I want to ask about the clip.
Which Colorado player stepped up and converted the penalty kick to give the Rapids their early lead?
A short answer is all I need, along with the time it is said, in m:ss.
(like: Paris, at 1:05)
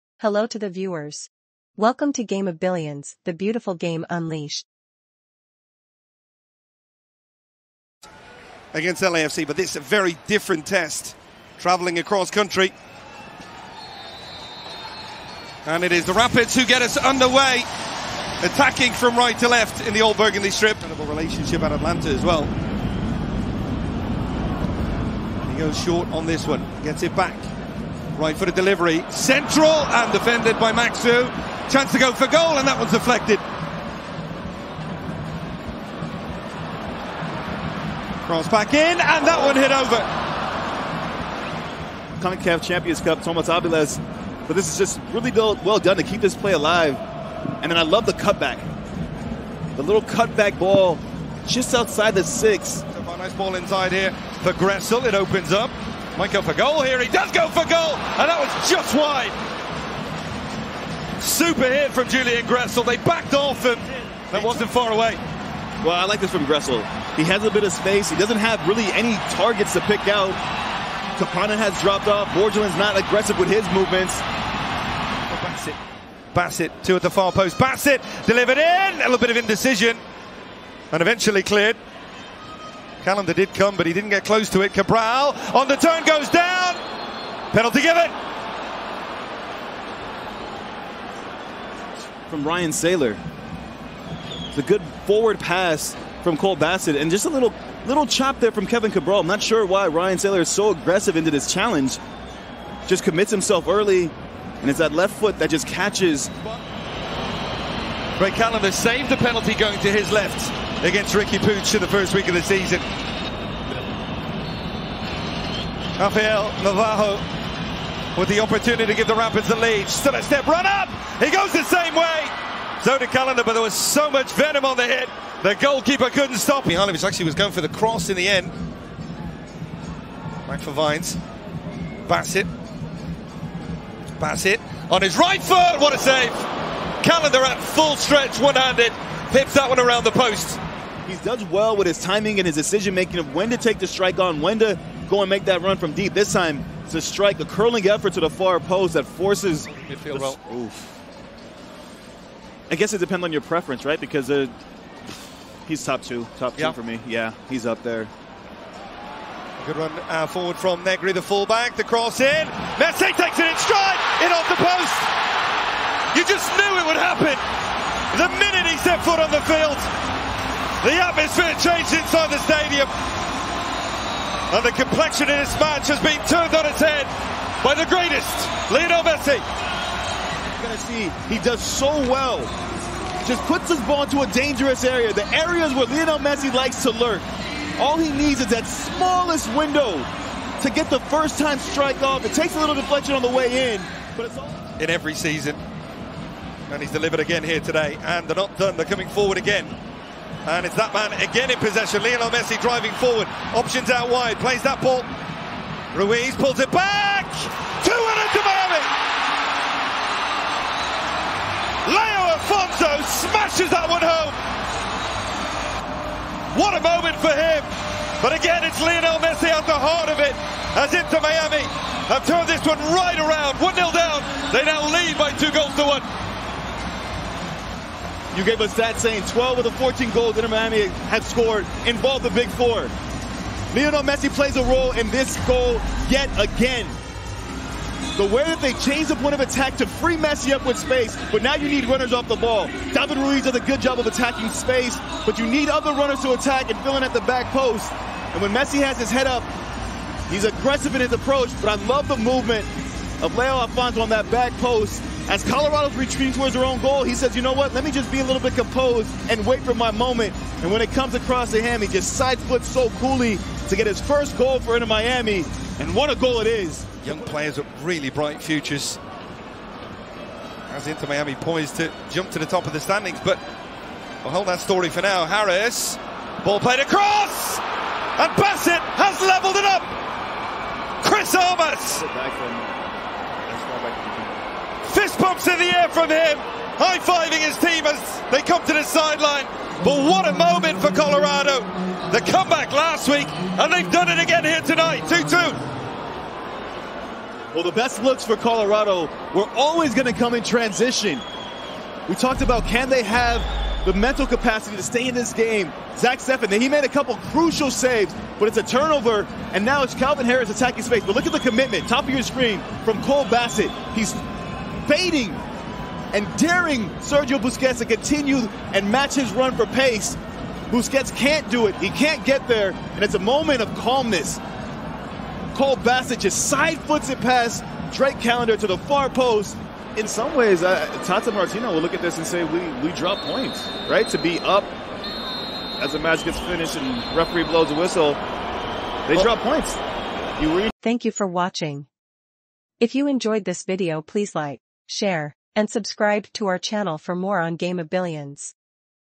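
Rafael Navarro, at 1:55.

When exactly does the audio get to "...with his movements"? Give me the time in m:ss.
1:13.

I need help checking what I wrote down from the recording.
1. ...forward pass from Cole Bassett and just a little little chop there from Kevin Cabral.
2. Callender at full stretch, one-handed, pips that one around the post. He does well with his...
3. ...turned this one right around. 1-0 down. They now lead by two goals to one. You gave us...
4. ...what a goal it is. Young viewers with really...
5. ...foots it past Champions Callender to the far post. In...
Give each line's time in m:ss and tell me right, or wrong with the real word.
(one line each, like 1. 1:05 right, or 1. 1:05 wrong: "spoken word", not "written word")
1. 1:35 right
2. 2:17 right
3. 3:42 right
4. 4:25 wrong: "players", not "viewers"
5. 5:26 wrong: "Drake", not "Champions".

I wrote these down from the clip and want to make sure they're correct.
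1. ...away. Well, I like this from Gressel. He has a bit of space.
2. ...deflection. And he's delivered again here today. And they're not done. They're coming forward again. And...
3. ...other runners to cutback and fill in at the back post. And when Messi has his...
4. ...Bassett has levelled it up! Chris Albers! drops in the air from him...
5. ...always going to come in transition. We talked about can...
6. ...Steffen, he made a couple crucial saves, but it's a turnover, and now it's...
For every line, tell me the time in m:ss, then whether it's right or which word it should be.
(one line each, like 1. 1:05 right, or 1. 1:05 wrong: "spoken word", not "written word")
1. 1:04 right
2. 3:15 wrong: "season", not "deflection"
3. 4:05 wrong: "attack", not "cutback"
4. 4:38 right
5. 4:59 right
6. 5:06 right.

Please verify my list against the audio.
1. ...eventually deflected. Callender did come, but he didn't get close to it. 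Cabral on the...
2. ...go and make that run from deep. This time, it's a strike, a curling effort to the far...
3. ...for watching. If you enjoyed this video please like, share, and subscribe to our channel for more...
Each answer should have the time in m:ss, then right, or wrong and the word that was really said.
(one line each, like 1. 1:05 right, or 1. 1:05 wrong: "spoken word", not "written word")
1. 1:21 wrong: "cleared", not "deflected"
2. 2:25 right
3. 5:41 right.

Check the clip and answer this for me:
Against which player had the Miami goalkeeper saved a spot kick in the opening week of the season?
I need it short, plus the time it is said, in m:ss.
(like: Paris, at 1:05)
Riqui Puig, at 1:51.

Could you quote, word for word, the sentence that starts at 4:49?
But what a moment for Colorado.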